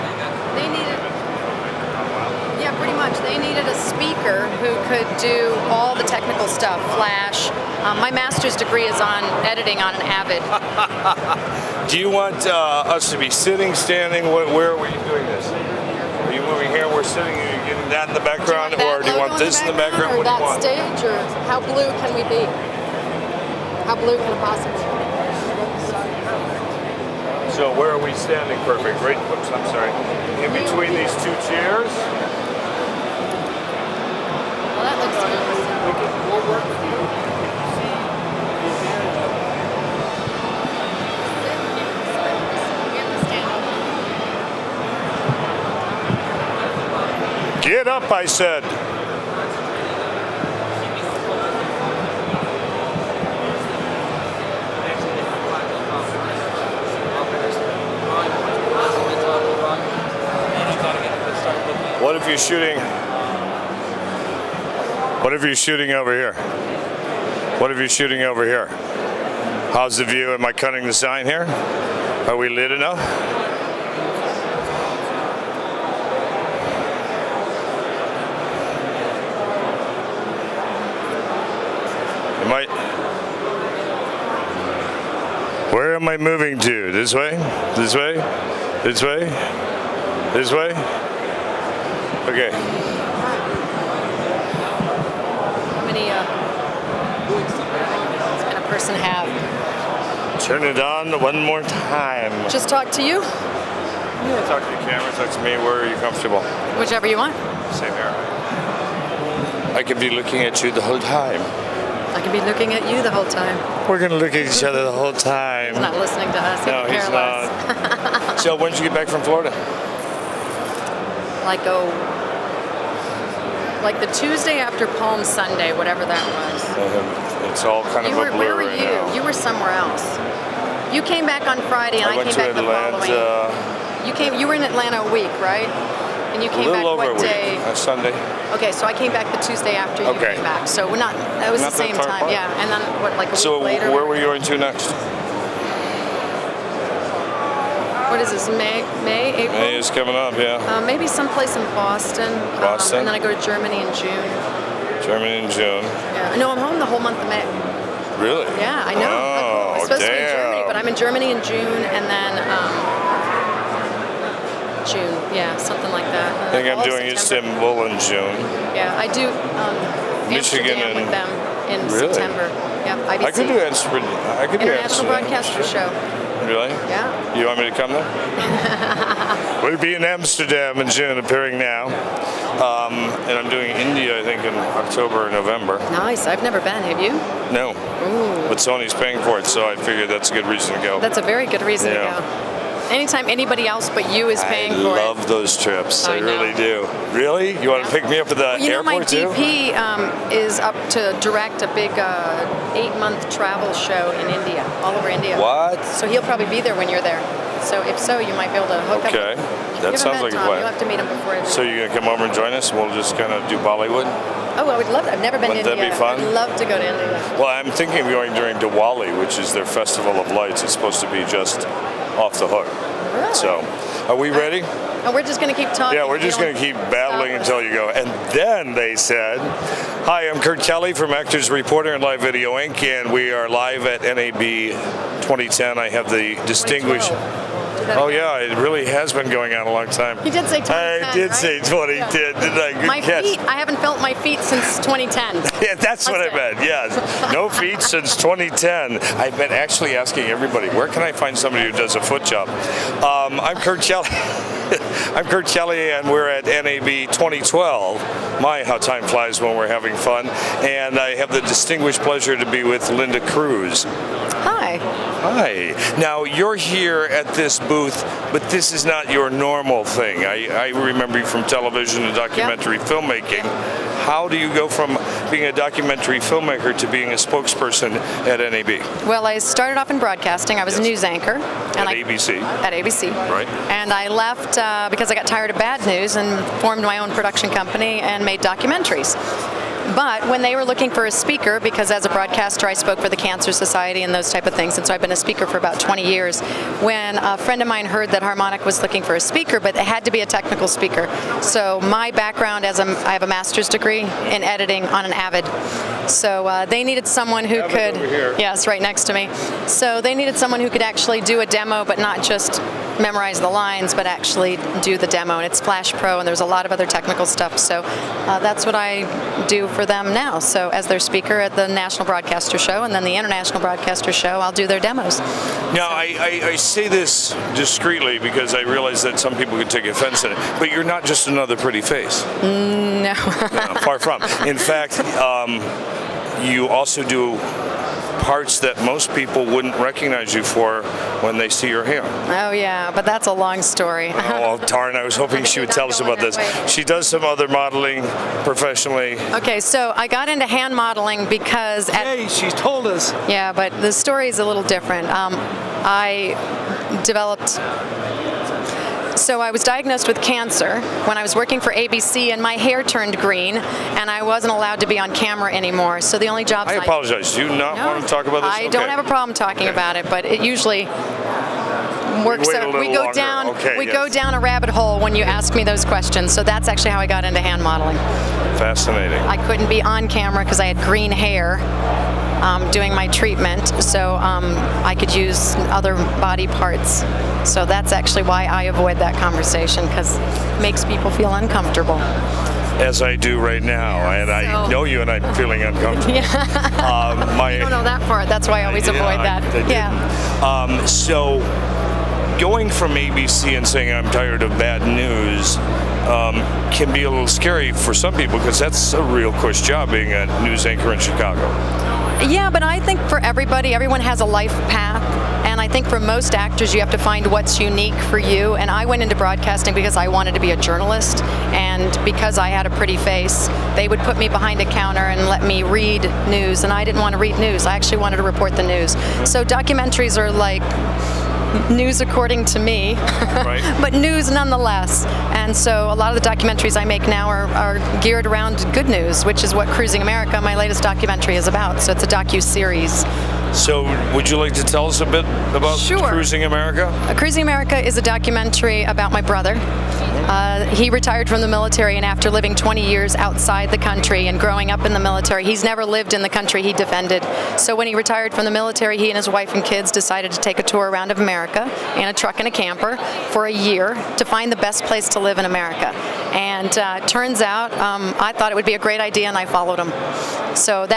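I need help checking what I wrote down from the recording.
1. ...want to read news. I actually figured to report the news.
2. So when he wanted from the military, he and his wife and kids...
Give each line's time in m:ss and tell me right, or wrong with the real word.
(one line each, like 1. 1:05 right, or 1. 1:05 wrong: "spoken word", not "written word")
1. 7:07 wrong: "wanted", not "figured"
2. 7:37 wrong: "retired", not "wanted".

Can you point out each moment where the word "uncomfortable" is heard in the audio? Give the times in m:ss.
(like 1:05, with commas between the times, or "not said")
6:31, 6:35.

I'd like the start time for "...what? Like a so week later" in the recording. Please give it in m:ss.
2:23.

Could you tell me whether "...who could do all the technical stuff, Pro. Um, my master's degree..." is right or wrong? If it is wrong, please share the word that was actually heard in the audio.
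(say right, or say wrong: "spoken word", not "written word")
wrong: "Flash", not "Pro".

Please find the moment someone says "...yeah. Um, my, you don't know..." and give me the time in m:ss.
6:36.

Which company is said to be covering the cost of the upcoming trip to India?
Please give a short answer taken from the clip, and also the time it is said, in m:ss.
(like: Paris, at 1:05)
Sony, at 3:08.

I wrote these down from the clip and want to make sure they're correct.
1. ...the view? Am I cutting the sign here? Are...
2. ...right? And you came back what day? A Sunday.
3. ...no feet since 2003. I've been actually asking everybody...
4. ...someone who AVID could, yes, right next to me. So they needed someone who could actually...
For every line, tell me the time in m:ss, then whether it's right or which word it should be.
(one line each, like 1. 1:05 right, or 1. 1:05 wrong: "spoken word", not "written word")
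1. 1:09 right
2. 2:15 right
3. 4:07 wrong: "2010", not "2003"
4. 5:07 right.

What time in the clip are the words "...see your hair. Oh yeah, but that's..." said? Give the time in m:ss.
5:41.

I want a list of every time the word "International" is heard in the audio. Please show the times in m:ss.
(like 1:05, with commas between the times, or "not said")
2:54, 5:23.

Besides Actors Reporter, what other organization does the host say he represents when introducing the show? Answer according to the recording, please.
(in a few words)
Live Video Inc.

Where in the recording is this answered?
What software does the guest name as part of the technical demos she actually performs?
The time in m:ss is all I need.
5:15.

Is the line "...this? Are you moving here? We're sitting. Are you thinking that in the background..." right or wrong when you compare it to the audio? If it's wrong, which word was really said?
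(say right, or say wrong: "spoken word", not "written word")
wrong: "getting", not "thinking".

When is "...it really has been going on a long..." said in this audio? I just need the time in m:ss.
3:58.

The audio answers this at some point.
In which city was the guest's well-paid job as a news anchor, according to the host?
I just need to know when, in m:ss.
6:51.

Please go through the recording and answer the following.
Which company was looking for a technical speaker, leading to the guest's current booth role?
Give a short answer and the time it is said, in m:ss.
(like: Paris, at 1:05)
Harmonic, at 4:58.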